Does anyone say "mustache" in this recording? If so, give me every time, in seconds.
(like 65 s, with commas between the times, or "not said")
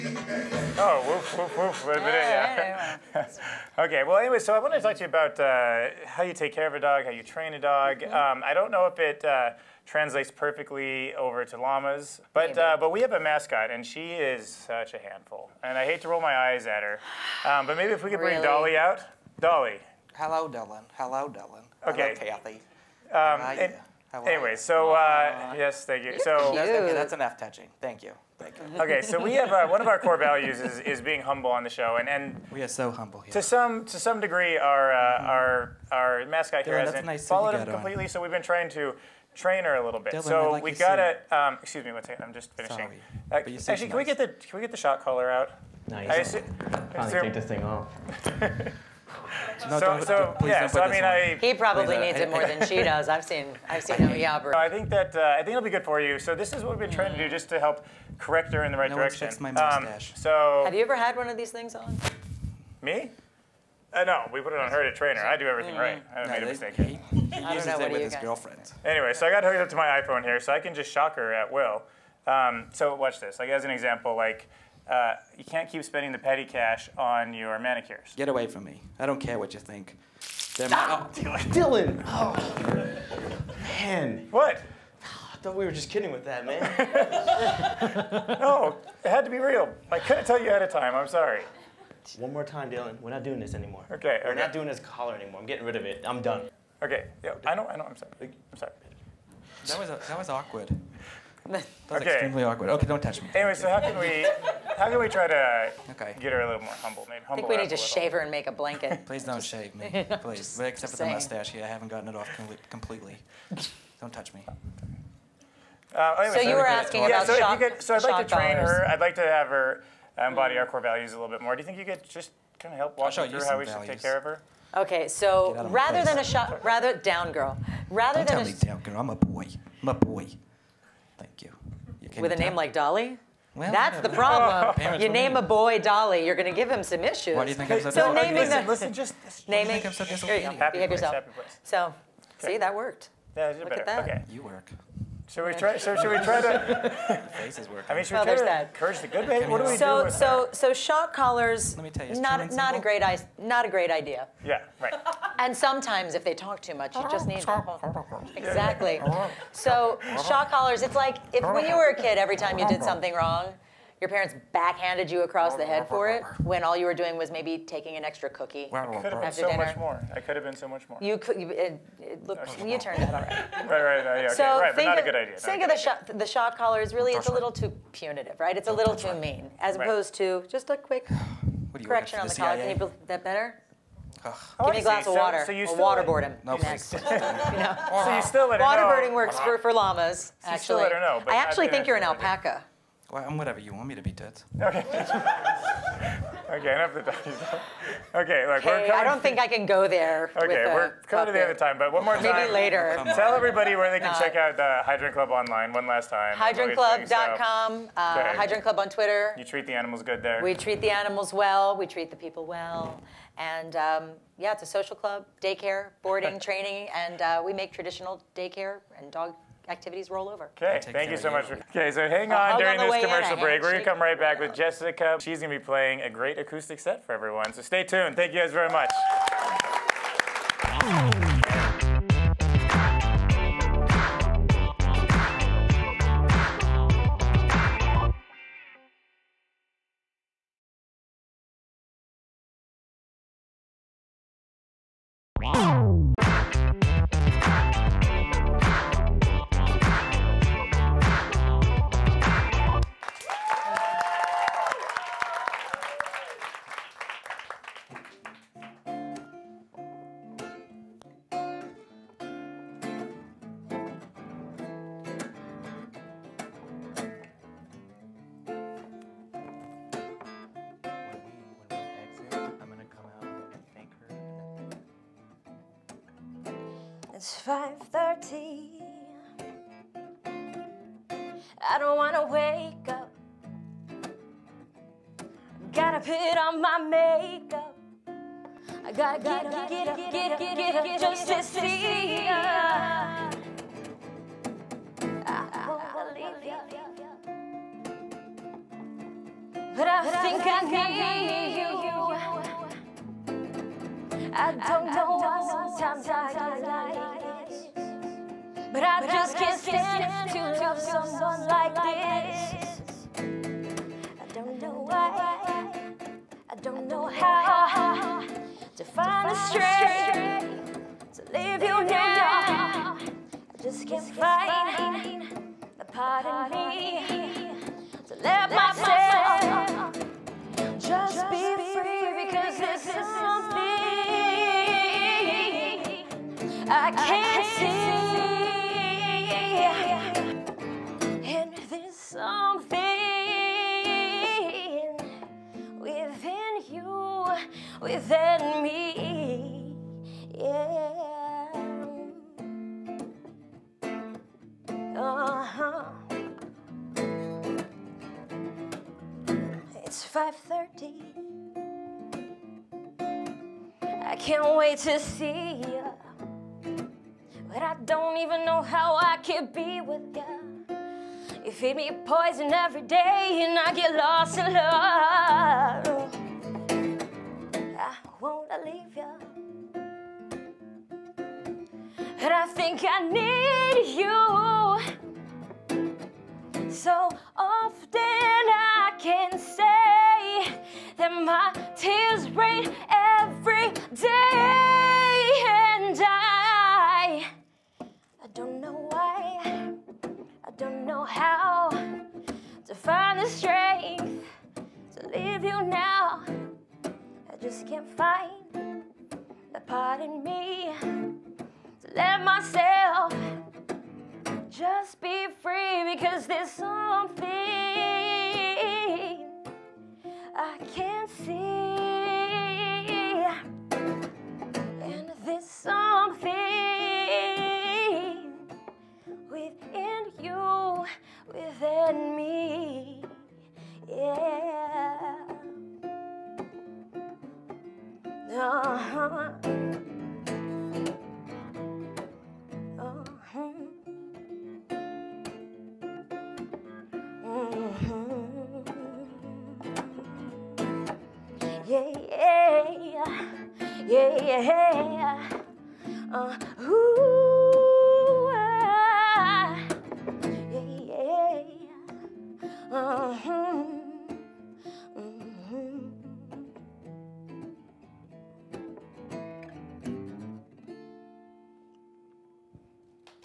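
59 s, 111 s.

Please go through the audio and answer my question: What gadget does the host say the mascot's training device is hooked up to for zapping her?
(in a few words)
iPhone.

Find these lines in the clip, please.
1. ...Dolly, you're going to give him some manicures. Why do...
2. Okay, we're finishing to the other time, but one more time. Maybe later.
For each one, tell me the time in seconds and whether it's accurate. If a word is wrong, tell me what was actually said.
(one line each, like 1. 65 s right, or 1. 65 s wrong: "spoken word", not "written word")
1. 135 s wrong: "issues", not "manicures"
2. 200 s wrong: "coming", not "finishing".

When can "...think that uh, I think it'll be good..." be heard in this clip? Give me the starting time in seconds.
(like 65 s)
54 s.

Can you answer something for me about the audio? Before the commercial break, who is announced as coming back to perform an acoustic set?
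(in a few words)
Jessica.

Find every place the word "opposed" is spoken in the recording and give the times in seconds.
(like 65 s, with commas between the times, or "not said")
179 s.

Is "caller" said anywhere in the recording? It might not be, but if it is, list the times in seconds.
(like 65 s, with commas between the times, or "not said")
45 s.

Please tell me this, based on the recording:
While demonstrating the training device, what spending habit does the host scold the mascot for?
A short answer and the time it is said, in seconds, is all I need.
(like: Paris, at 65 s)
Manicures, at 77 s.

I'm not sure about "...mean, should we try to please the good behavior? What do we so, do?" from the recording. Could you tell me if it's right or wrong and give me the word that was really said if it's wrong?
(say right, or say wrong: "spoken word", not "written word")
wrong: "curse", not "please".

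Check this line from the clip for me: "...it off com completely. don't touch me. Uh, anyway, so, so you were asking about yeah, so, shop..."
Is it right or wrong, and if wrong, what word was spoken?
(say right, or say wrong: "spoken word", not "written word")
right.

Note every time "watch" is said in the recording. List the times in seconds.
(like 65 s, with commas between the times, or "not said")
72 s.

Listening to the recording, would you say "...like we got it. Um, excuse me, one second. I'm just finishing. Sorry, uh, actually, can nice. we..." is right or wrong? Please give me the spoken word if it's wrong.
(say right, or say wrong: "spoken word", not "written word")
right.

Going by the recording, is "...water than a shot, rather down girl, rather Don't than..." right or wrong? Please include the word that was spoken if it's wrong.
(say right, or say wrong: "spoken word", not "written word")
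wrong: "rather", not "water".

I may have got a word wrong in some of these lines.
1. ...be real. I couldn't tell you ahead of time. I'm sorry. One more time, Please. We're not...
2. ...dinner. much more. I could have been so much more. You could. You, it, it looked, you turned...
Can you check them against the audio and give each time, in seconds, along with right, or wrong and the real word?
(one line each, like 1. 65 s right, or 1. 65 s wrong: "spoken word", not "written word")
1. 89 s wrong: "Dylan", not "Please"
2. 169 s right.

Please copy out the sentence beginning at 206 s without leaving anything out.
HydrantClub.com, uh, Hydrant Club on Twitter.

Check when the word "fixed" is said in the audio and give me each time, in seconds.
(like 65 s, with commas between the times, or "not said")
59 s.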